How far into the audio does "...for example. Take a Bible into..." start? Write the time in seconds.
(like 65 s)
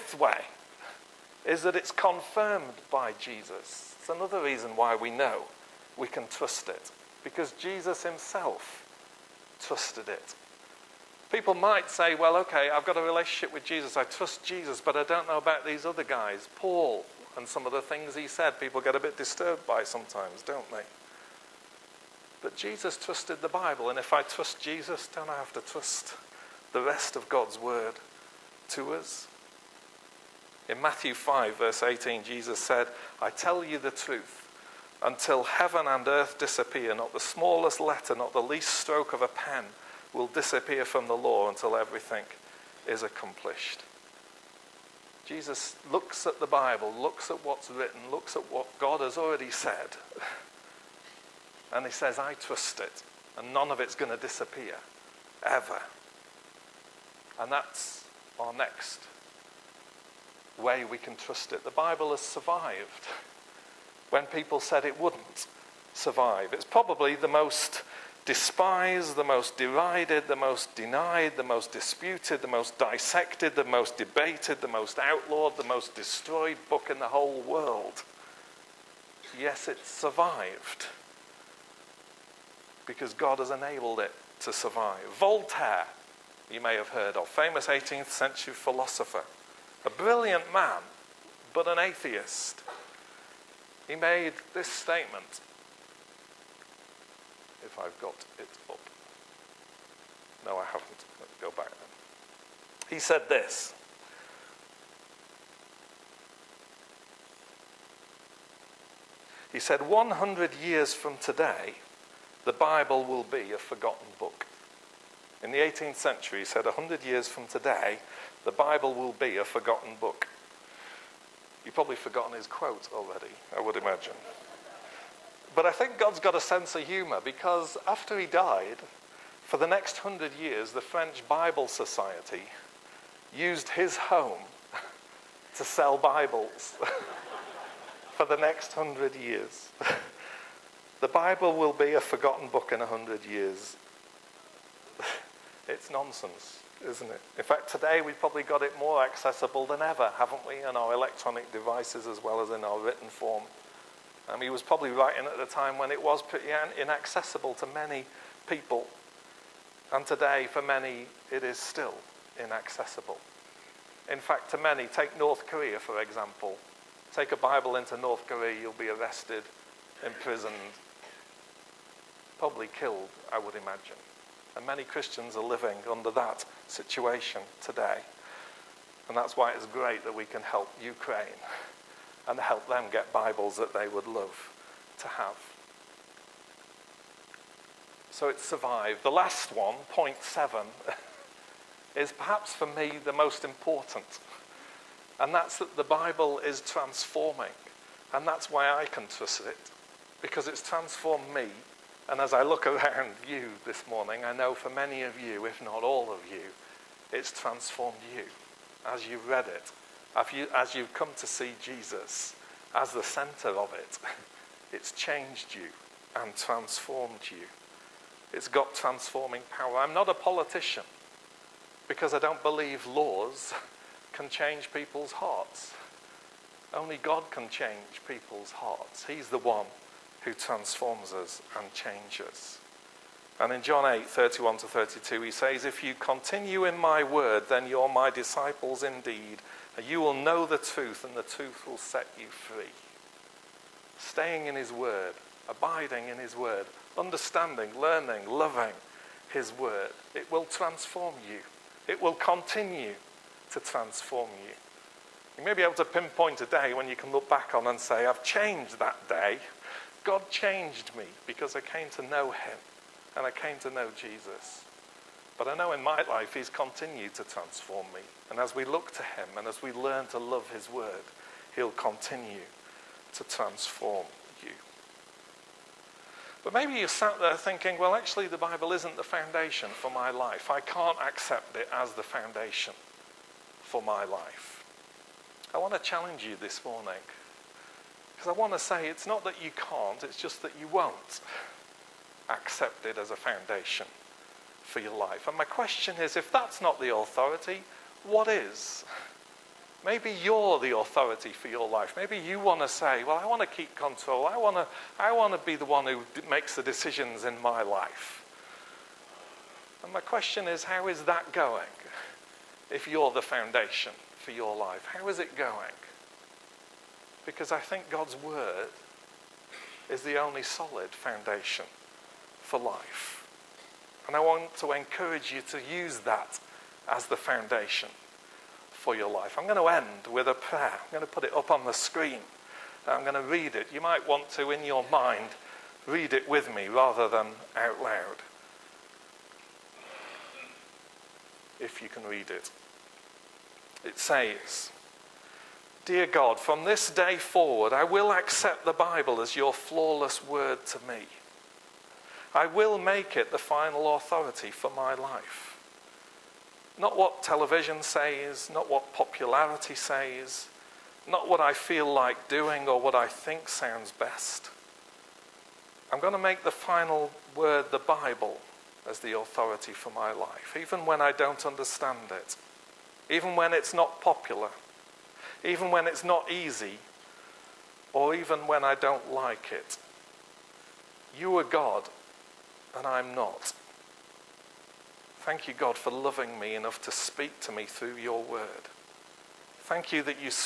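165 s.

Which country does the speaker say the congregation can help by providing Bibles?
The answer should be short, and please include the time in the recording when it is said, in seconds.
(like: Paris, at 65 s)
Ukraine, at 180 s.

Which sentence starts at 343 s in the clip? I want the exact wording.
It says, Dear God, from this day forward, I will accept the Bible as your flawless word to me.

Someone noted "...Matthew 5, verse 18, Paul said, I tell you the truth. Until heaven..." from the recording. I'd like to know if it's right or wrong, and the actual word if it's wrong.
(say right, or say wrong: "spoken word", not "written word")
wrong: "Jesus", not "Paul".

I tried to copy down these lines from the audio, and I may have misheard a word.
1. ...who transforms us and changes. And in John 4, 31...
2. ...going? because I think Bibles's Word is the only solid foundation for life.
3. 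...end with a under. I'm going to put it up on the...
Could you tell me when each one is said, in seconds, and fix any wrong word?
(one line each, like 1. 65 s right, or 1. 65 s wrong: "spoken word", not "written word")
1. 230 s wrong: "8", not "4"
2. 315 s wrong: "God", not "Bibles"
3. 329 s wrong: "prayer", not "under".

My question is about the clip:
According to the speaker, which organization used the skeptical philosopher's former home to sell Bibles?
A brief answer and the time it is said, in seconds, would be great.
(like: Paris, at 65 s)
French Bible Society, at 130 s.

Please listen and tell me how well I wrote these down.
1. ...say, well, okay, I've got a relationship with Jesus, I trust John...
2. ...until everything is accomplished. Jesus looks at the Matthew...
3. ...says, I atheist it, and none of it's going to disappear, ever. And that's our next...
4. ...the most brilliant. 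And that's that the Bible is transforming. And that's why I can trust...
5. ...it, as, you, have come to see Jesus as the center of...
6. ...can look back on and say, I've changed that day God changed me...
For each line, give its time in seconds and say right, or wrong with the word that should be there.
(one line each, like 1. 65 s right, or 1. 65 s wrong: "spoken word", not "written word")
1. 11 s wrong: "Jesus", not "John"
2. 41 s wrong: "Bible", not "Matthew"
3. 51 s wrong: "trust", not "atheist"
4. 193 s wrong: "important", not "brilliant"
5. 209 s right
6. 256 s right.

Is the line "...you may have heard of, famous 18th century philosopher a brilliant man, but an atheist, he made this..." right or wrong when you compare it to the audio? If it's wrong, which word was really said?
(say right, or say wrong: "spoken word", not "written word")
right.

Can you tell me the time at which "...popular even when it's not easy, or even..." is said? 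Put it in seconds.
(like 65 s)
374 s.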